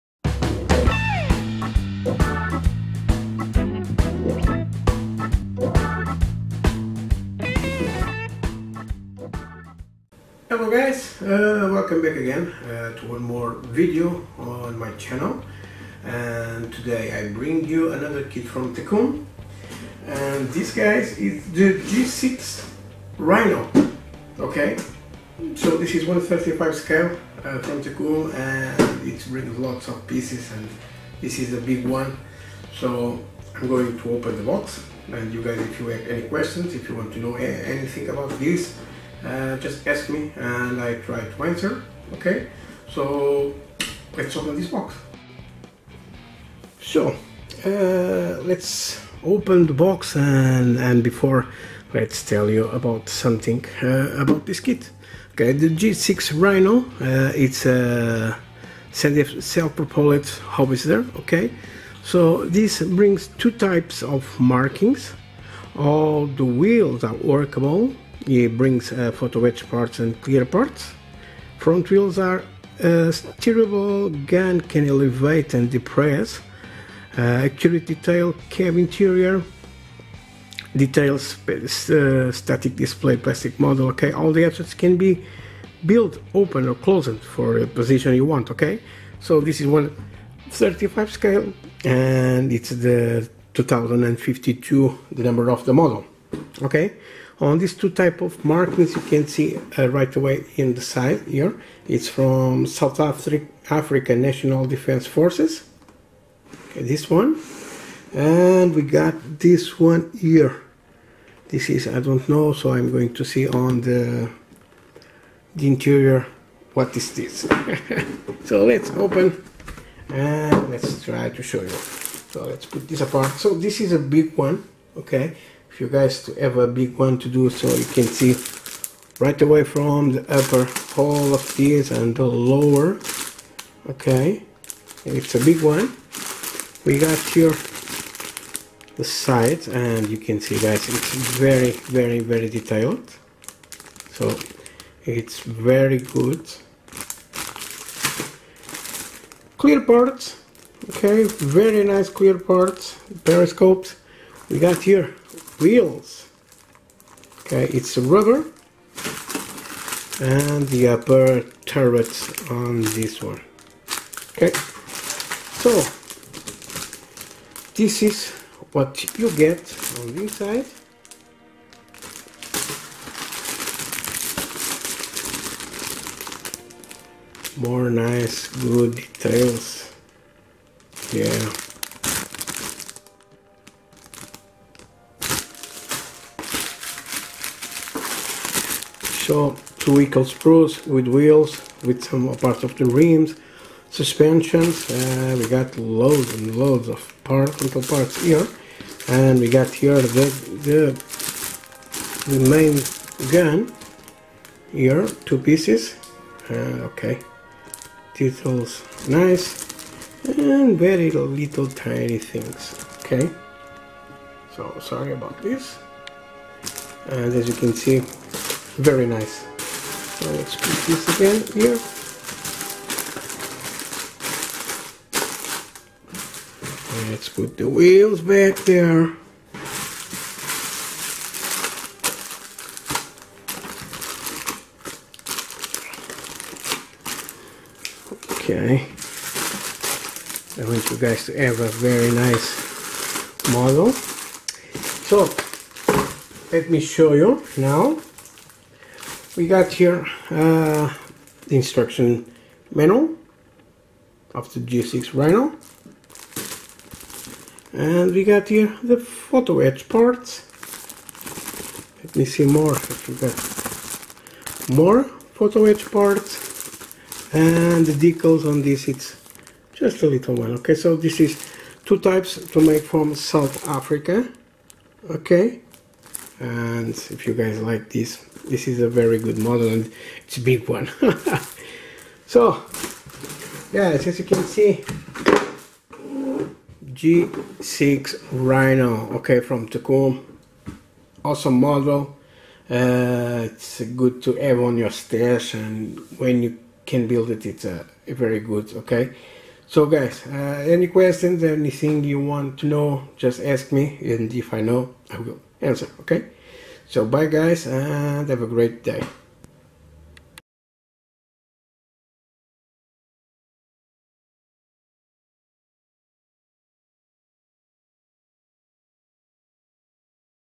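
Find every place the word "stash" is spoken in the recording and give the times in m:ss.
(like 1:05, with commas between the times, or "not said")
4:54.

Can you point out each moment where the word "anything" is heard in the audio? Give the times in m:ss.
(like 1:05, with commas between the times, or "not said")
0:37, 5:01.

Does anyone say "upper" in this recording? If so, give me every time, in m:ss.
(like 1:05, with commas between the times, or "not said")
2:10, 2:40.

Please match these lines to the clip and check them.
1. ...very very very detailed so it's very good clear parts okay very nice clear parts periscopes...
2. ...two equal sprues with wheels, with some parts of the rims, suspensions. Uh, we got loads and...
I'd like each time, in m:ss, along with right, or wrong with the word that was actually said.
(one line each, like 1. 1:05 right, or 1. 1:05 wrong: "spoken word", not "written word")
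1. 2:21 right
2. 3:09 right.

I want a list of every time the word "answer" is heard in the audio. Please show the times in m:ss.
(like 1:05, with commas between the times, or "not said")
0:41, 5:05.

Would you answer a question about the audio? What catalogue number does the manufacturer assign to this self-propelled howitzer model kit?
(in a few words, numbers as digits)
2052.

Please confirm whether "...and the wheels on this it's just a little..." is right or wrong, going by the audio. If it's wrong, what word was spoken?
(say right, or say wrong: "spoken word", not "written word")
wrong: "decals", not "wheels".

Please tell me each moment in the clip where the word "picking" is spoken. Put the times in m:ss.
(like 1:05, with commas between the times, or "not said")
not said.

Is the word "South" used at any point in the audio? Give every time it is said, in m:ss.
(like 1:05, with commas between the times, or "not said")
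1:42, 4:33.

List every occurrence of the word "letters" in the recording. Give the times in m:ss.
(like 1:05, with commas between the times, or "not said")
not said.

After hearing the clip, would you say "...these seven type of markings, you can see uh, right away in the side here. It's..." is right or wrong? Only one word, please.
wrong.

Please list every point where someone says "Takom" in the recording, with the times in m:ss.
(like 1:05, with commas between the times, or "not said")
0:18, 0:27.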